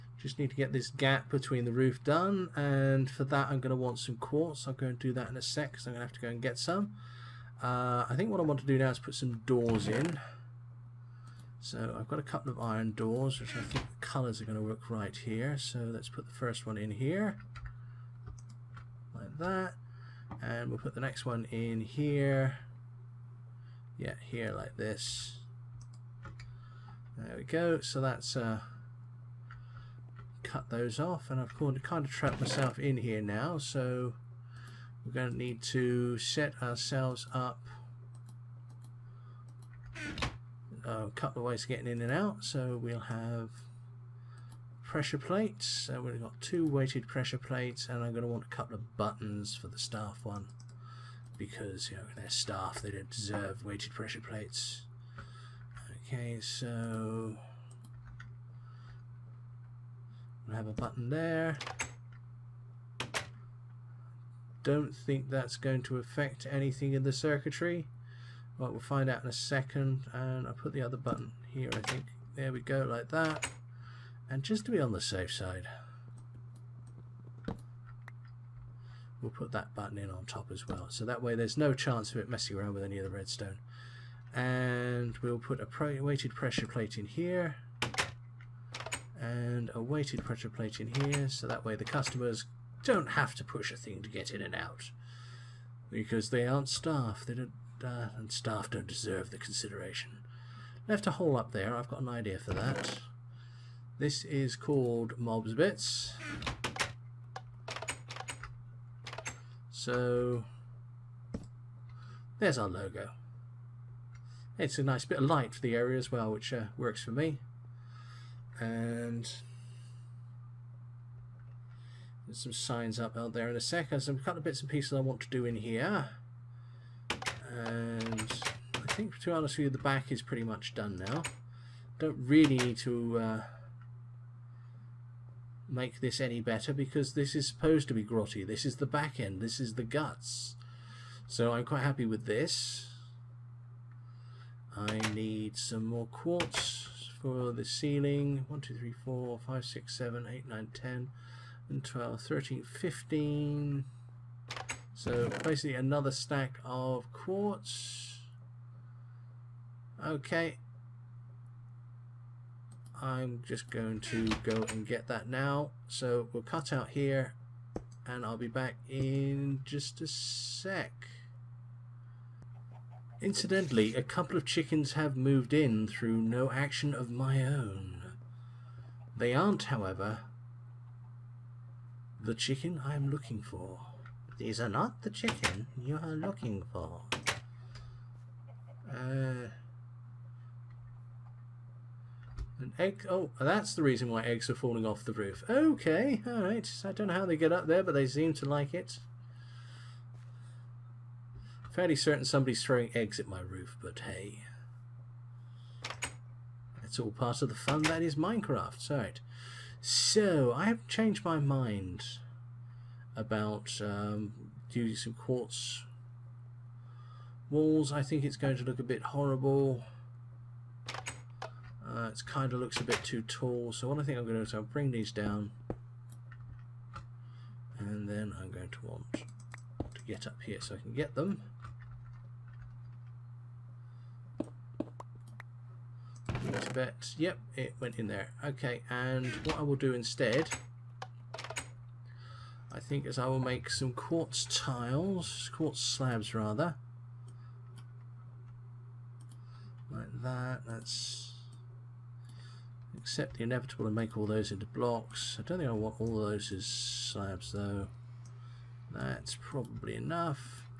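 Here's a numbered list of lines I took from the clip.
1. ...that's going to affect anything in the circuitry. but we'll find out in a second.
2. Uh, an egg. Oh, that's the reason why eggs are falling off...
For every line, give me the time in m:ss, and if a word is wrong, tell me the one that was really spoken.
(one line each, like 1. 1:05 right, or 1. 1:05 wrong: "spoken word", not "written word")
1. 1:05 right
2. 3:08 right.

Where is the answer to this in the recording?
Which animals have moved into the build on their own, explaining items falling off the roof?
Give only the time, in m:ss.
2:54.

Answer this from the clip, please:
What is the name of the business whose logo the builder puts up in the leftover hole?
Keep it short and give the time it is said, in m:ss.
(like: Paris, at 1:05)
Mobzbitz, at 1:45.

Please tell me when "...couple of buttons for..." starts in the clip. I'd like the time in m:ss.
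0:48.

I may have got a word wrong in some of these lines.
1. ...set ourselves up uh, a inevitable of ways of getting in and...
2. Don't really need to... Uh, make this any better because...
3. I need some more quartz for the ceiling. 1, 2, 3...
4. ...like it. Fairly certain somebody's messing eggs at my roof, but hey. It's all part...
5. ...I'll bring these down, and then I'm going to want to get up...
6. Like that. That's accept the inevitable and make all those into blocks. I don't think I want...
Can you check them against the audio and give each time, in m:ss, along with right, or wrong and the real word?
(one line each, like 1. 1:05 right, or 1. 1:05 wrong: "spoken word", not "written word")
1. 0:36 wrong: "couple", not "inevitable"
2. 2:11 right
3. 2:24 right
4. 3:18 wrong: "throwing", not "messing"
5. 3:44 right
6. 4:09 right.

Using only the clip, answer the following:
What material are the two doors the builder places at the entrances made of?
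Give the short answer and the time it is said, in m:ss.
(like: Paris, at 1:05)
Iron, at 0:12.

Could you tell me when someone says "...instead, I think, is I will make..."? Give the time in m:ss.
3:59.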